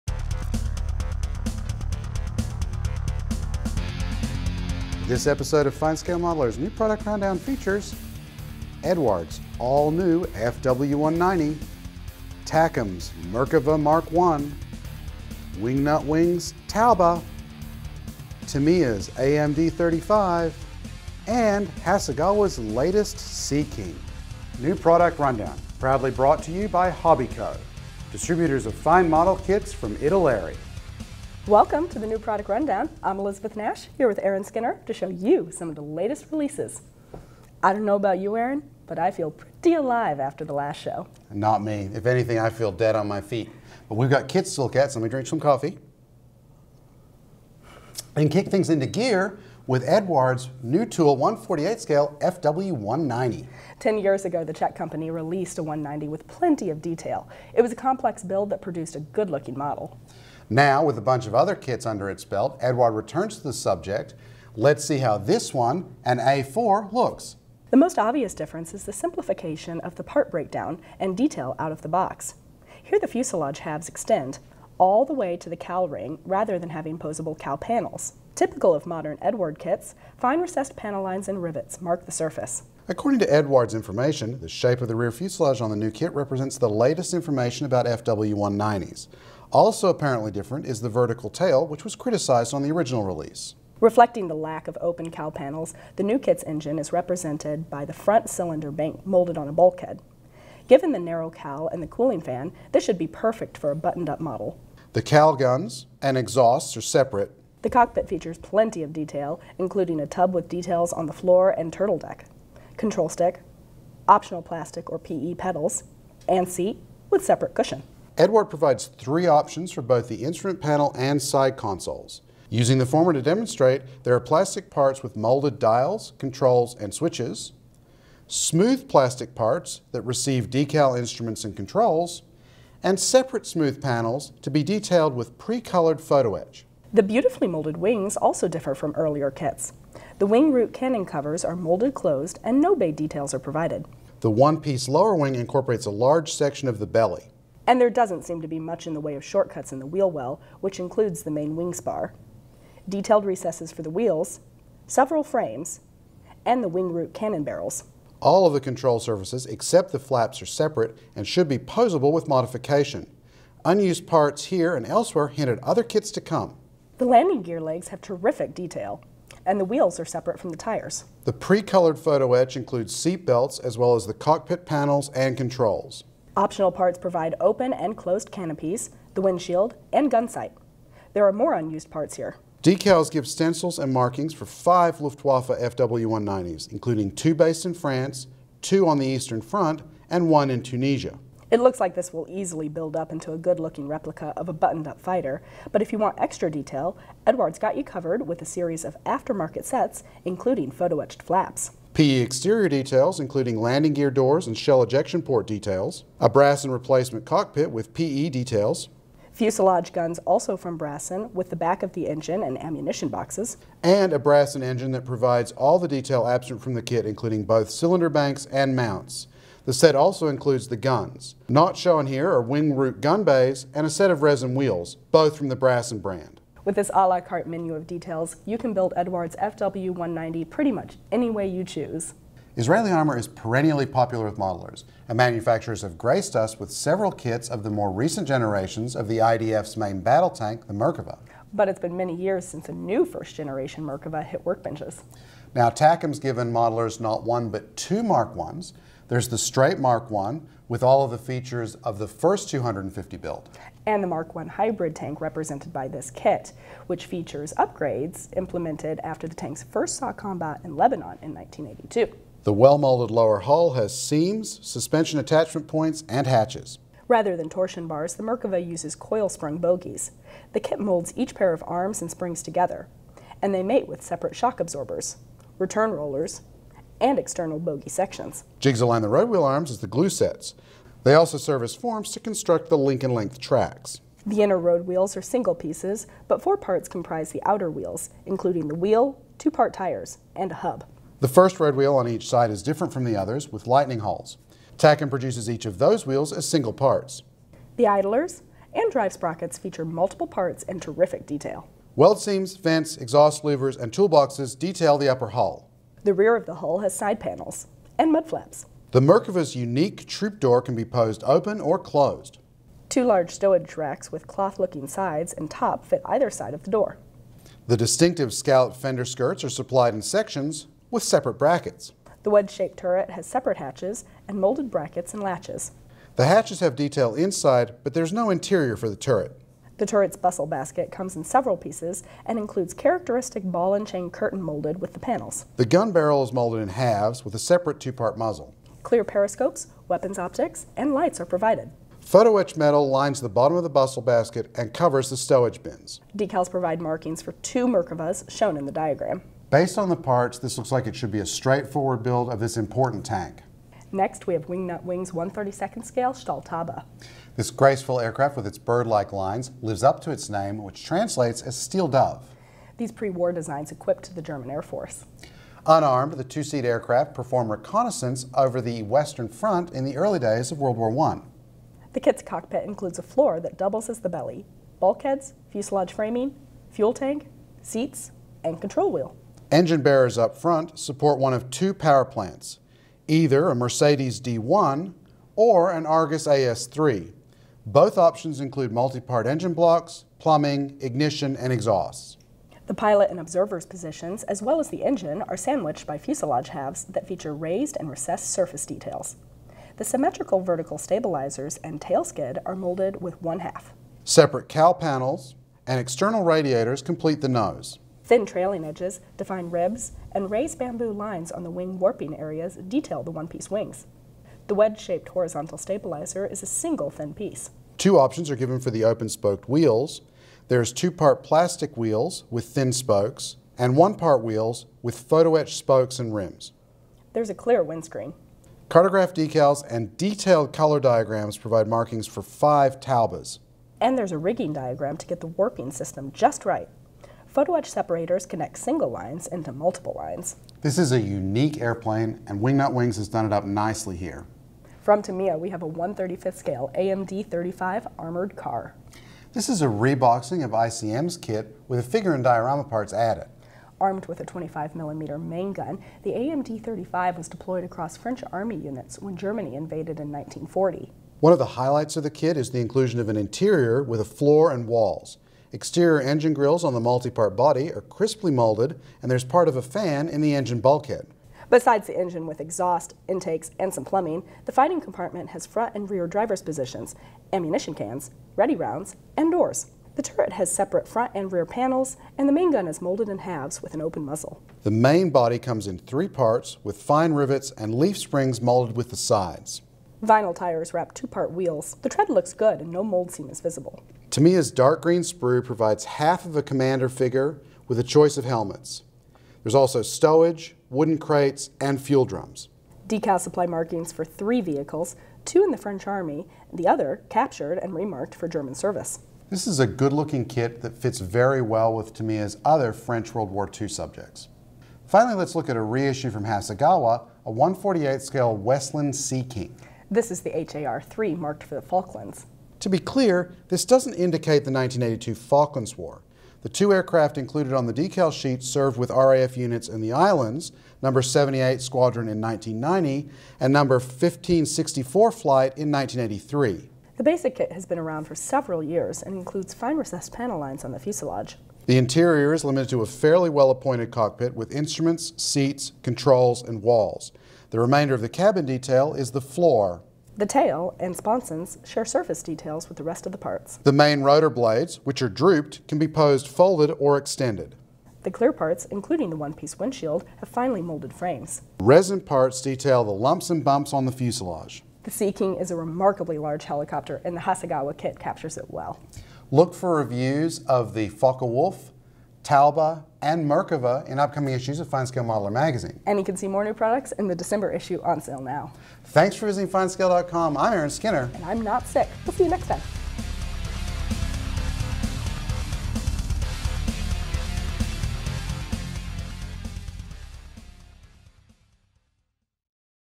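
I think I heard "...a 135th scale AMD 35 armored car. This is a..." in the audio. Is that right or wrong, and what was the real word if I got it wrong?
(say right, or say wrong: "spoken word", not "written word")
right.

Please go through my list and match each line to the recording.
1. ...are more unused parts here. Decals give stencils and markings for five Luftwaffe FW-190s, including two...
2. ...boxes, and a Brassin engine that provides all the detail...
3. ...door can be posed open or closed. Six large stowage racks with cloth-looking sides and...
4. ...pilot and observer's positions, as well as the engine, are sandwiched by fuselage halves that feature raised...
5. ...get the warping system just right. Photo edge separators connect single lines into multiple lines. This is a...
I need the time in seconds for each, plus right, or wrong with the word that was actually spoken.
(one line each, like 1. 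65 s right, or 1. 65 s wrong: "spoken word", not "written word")
1. 181 s right
2. 213 s right
3. 310 s wrong: "Two", not "Six"
4. 392 s right
5. 435 s right.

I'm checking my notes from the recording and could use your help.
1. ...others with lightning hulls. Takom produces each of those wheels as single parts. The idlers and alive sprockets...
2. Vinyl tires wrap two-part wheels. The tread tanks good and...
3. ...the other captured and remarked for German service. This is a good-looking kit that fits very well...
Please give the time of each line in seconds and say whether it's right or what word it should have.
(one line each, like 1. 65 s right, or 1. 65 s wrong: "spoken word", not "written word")
1. 293 s wrong: "drive", not "alive"
2. 490 s wrong: "looks", not "tanks"
3. 506 s right.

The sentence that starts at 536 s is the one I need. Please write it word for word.
The basic kit has been around for several years and includes fine recessed panel lines on the fuselage.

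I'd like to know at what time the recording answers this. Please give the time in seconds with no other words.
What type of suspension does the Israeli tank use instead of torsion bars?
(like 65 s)
268 s.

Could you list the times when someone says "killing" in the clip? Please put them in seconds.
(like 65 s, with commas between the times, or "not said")
not said.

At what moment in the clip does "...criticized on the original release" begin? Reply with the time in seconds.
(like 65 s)
91 s.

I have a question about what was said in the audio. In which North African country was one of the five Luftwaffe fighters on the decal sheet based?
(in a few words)
Tunisia.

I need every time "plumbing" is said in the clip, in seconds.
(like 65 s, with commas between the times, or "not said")
390 s, 473 s.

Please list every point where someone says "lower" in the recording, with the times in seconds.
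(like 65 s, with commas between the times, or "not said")
144 s, 263 s.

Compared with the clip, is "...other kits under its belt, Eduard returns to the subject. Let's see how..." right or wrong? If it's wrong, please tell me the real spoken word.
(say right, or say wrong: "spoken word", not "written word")
right.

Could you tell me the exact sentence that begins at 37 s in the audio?
I don't know about you, Aaron, but I feel pretty alive after the last show.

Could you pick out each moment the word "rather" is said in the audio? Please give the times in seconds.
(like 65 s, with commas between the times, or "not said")
76 s, 267 s.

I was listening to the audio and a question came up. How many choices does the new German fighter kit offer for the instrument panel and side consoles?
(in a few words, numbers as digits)
3.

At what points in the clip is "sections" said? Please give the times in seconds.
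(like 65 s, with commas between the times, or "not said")
146 s, 277 s, 320 s.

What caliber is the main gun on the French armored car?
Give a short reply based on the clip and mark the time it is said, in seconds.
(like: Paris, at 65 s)
25mm, at 454 s.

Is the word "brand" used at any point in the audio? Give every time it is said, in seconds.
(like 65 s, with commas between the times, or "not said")
226 s.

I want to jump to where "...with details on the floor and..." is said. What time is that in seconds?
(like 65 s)
110 s.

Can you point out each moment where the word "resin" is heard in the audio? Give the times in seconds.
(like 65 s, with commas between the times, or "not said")
224 s, 561 s.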